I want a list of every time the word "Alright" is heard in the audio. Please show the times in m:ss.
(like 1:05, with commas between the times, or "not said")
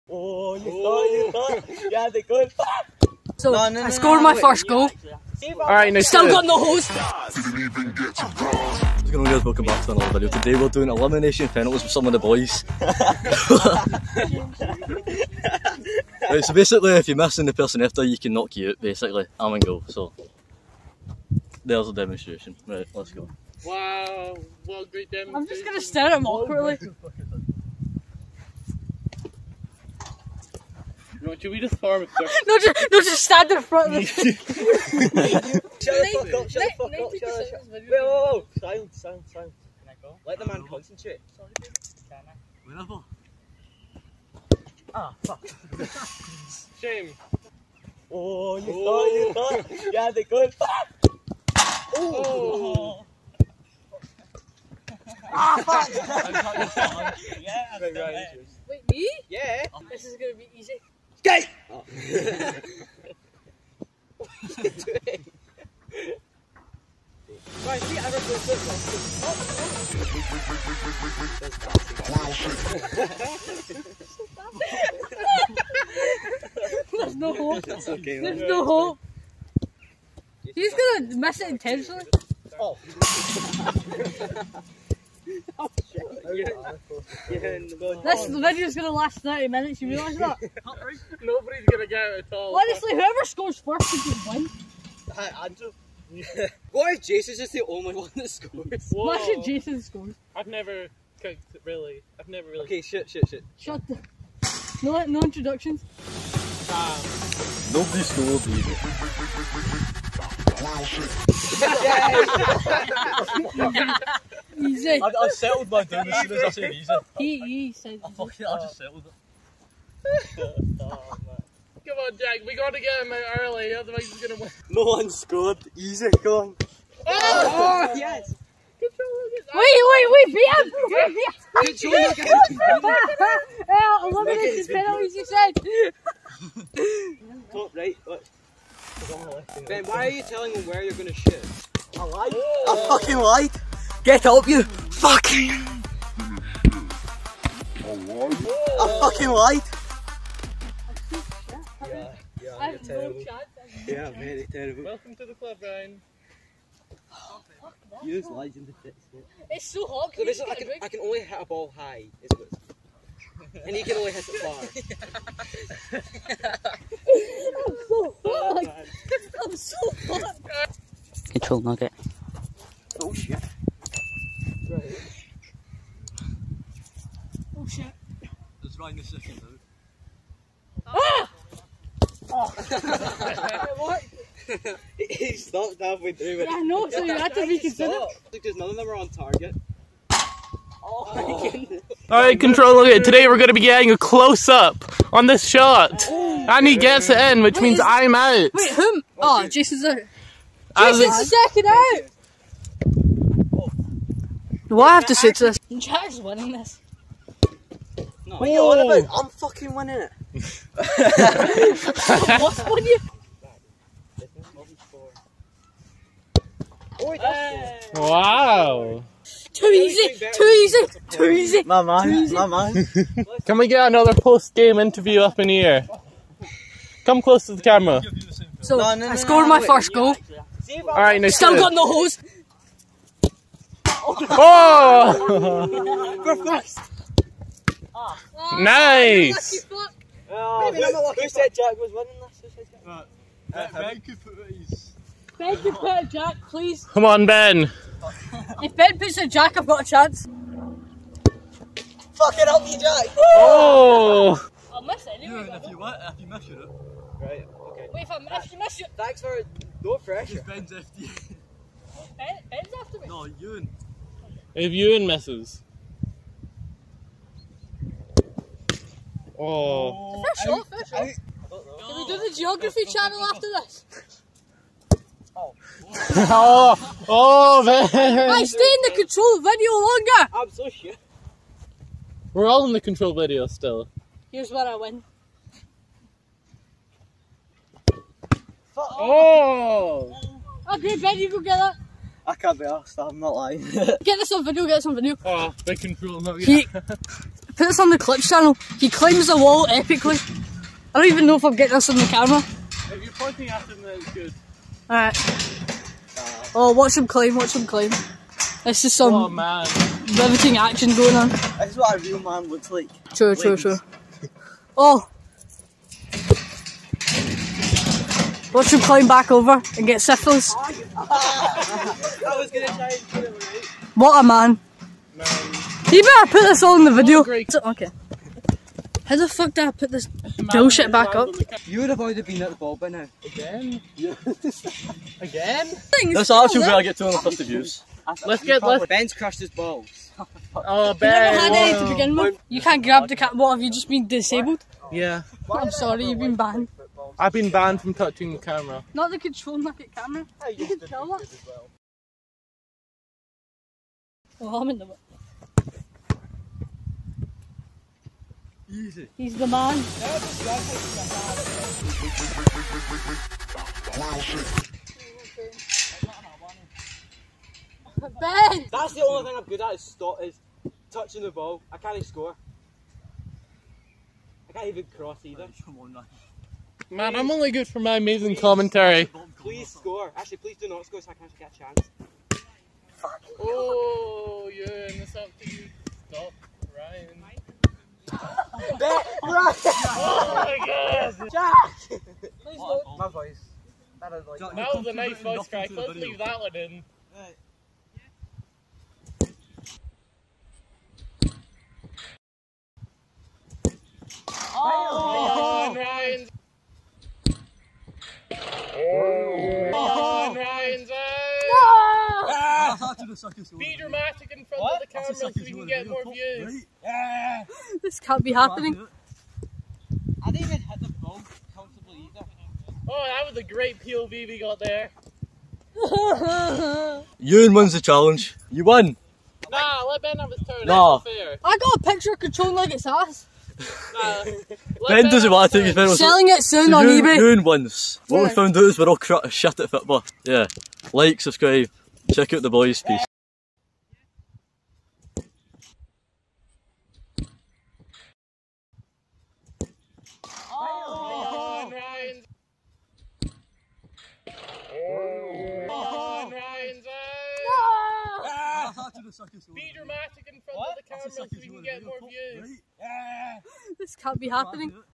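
0:05, 3:12, 3:50, 5:04.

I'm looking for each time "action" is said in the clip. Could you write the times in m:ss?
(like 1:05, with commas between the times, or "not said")
5:10.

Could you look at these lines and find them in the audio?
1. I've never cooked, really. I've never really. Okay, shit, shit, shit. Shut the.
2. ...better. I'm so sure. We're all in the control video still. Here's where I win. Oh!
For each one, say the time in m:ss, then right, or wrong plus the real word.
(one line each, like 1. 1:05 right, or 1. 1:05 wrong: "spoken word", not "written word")
1. 1:40 right
2. 4:39 wrong: "longer", not "better".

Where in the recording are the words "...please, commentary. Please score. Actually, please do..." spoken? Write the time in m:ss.
6:18.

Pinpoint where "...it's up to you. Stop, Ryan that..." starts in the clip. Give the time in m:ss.
6:25.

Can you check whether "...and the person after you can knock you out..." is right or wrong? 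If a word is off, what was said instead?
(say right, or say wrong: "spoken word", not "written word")
right.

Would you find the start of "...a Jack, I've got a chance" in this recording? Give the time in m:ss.
4:09.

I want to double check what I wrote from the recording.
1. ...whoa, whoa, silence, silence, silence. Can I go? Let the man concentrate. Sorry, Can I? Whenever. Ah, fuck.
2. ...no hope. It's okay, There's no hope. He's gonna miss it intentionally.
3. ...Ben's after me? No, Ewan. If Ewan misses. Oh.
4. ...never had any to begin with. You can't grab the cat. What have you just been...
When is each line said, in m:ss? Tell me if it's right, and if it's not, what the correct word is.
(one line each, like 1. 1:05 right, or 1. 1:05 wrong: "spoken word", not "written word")
1. 0:37 right
2. 1:17 right
3. 4:22 right
4. 5:41 right.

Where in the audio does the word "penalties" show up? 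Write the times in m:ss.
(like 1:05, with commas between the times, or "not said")
0:11, 2:14.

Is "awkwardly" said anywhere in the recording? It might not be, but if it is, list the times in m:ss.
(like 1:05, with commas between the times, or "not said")
0:26.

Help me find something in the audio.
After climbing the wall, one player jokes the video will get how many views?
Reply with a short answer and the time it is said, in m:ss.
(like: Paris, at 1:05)
250, at 5:36.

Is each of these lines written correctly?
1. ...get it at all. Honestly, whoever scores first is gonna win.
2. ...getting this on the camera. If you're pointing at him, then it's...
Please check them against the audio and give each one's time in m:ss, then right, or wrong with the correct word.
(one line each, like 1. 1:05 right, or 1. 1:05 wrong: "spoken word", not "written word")
1. 1:31 right
2. 5:01 right.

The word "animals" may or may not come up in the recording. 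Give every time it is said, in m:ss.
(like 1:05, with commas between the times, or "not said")
not said.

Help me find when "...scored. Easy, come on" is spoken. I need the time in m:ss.
2:05.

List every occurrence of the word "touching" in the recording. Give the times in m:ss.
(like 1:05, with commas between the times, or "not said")
5:47, 6:10.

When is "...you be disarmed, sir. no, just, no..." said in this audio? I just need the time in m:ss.
0:31.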